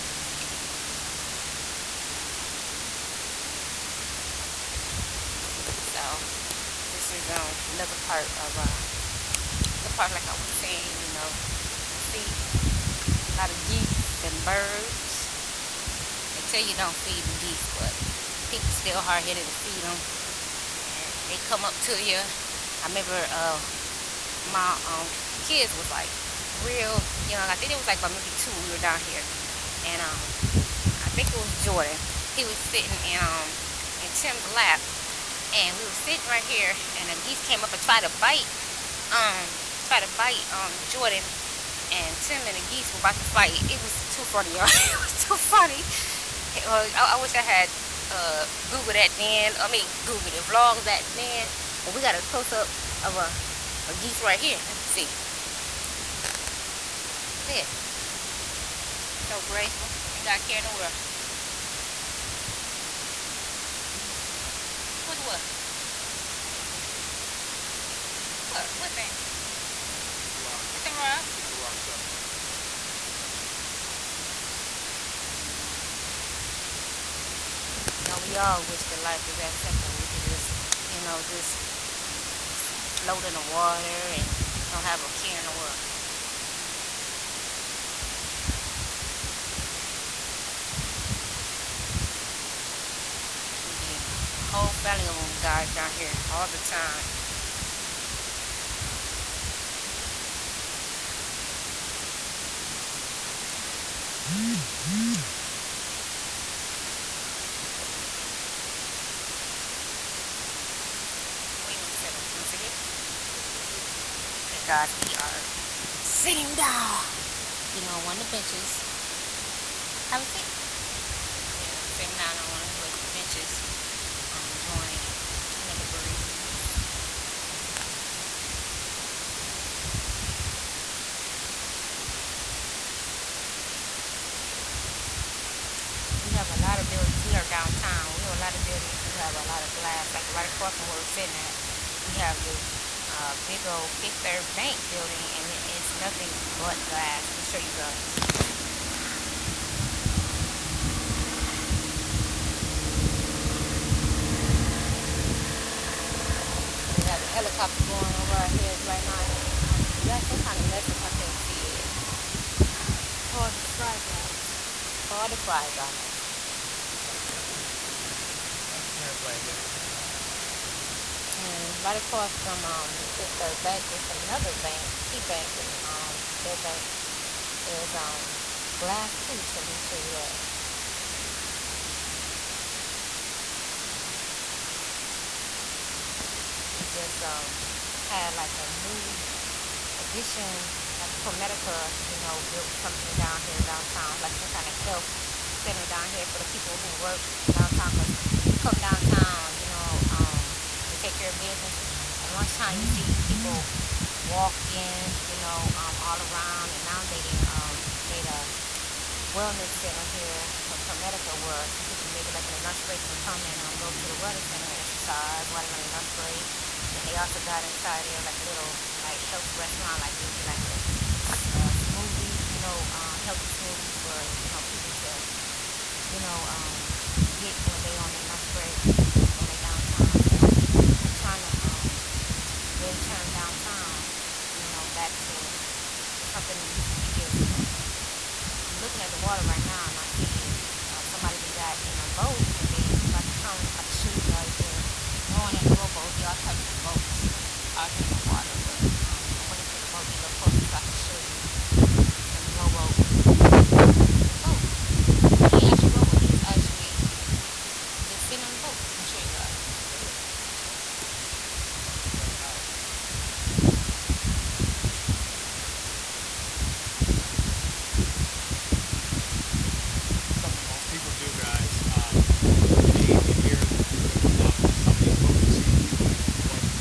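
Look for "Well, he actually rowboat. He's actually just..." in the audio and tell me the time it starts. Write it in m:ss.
4:14.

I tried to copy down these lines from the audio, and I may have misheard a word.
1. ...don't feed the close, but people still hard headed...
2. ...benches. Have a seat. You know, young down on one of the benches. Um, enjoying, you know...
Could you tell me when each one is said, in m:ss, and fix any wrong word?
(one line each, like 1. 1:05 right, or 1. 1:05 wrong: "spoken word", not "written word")
1. 0:16 wrong: "geese", not "close"
2. 1:58 wrong: "sitting", not "young".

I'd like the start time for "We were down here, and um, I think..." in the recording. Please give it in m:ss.
0:28.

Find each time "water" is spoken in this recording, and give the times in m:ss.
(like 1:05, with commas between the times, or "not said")
1:23, 3:59, 4:08.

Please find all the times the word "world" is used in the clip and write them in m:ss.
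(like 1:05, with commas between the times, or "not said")
1:00, 1:25.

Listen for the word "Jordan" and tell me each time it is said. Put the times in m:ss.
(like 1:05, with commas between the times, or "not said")
0:31, 0:40.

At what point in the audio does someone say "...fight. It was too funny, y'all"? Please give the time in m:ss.
0:43.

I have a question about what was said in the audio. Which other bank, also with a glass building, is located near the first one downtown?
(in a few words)
Key Bank.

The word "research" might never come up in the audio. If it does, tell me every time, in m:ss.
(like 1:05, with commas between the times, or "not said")
not said.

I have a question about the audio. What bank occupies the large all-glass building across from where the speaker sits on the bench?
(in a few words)
Fifth Third Bank.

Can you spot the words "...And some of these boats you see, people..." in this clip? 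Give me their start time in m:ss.
4:34.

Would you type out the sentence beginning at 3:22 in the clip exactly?
At lunchtime, you see people walking, you know, um, all around.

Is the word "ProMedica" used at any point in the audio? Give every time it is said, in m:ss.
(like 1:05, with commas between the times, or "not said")
3:11, 3:30.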